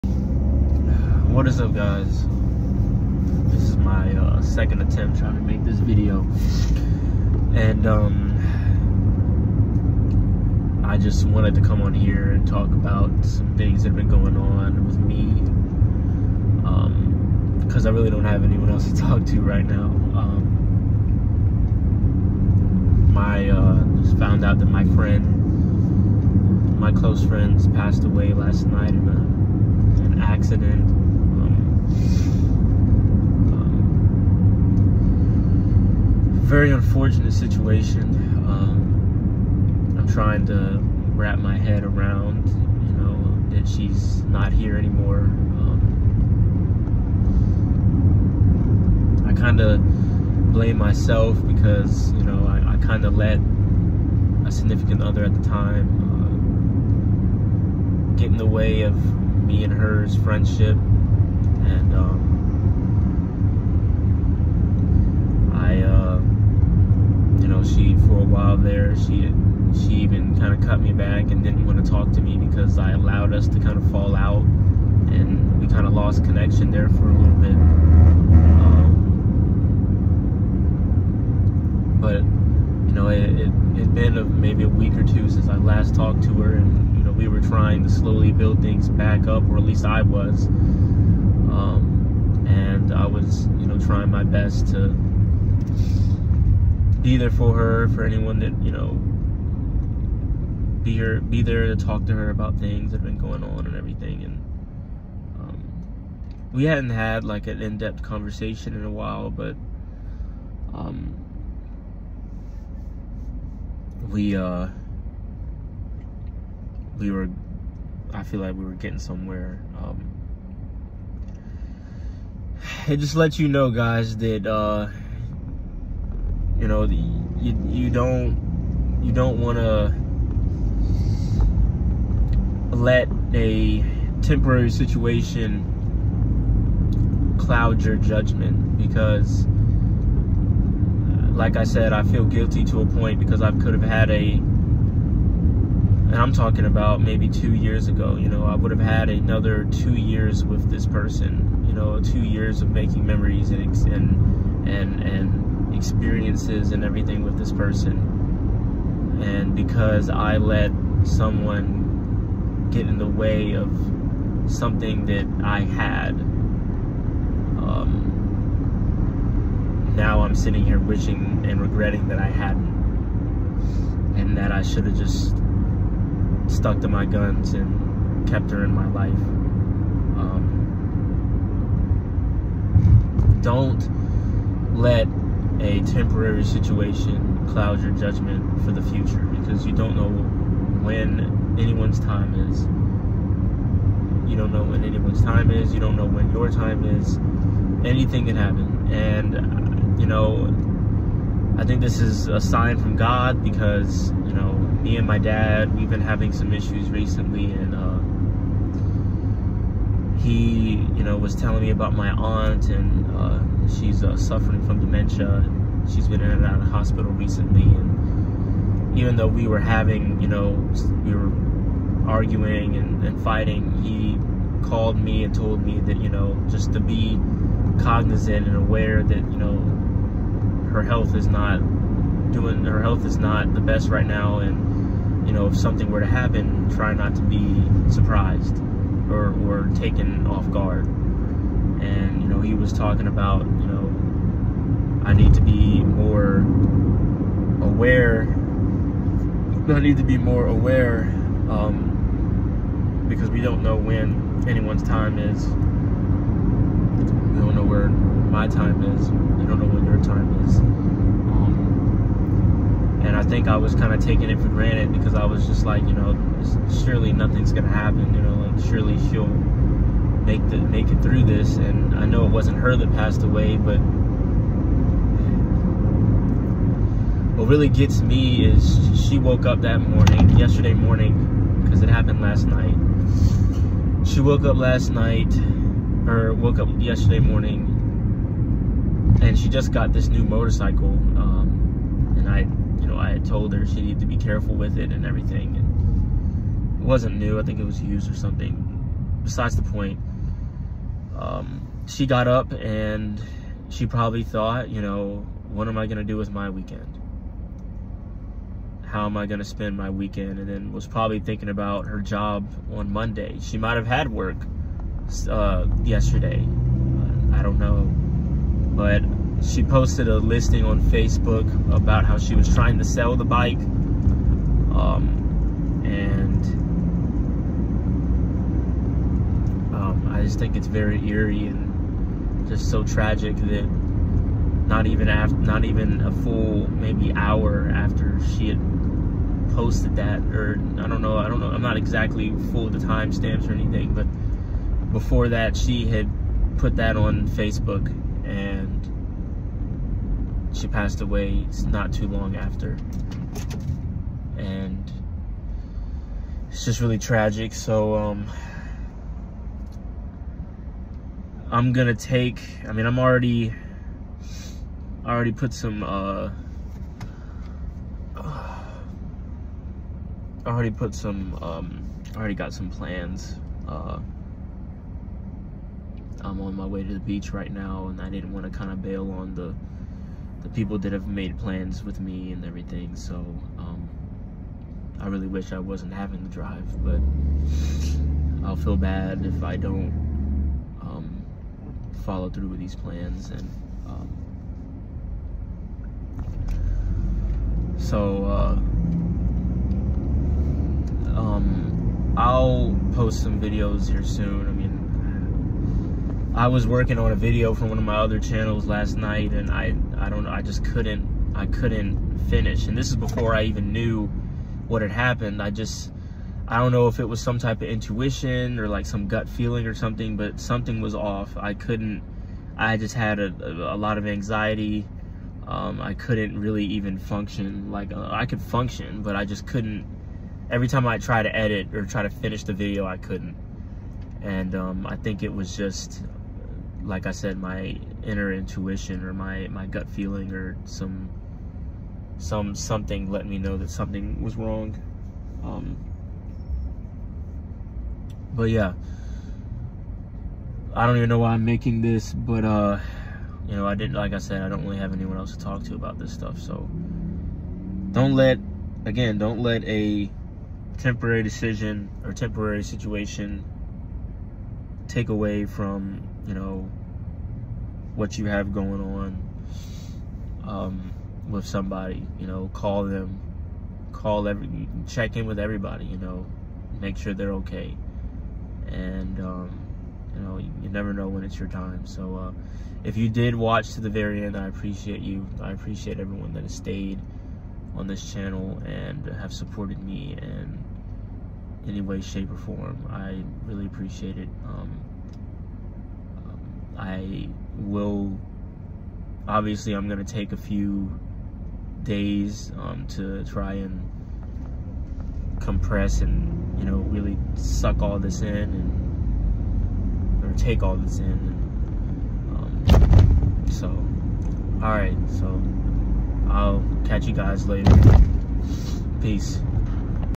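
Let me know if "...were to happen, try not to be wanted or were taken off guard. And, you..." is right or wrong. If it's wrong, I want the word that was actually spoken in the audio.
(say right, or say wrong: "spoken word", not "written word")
wrong: "surprised", not "wanted".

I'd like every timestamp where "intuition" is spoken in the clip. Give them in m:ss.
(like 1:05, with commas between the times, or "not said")
6:57, 7:18.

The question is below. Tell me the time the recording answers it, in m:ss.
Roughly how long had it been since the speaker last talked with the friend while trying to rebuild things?
1:24.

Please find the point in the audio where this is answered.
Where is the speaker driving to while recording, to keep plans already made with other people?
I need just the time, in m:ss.
6:16.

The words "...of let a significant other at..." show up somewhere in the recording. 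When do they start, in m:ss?
0:53.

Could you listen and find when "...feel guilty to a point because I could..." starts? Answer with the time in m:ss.
2:22.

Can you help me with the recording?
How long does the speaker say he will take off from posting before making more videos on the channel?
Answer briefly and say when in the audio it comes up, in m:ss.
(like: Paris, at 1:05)
A few days, at 8:20.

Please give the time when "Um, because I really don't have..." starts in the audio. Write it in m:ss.
0:16.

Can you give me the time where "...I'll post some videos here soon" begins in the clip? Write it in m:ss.
6:42.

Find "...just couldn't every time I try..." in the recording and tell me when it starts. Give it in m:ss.
7:09.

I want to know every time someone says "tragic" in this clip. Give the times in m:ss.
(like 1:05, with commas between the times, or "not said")
5:32, 5:56.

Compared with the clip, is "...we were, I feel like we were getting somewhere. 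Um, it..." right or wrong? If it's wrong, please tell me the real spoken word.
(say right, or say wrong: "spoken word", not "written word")
right.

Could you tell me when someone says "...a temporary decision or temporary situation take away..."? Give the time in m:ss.
7:39.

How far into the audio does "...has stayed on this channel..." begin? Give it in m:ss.
8:06.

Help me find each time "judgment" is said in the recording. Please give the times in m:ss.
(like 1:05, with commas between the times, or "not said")
2:17, 3:07.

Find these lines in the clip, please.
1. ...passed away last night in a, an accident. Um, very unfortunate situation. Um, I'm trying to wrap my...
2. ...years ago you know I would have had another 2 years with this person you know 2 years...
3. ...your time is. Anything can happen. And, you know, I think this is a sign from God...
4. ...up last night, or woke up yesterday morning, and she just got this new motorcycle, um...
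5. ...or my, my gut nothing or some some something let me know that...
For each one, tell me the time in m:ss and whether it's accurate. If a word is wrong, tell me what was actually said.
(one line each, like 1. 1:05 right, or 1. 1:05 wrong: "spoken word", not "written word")
1. 0:27 right
2. 2:27 right
3. 3:16 right
4. 4:44 right
5. 7:19 wrong: "feeling", not "nothing".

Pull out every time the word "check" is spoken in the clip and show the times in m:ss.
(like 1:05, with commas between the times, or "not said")
7:54.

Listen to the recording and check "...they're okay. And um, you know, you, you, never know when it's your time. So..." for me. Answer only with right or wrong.
right.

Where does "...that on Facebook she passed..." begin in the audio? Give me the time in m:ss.
5:46.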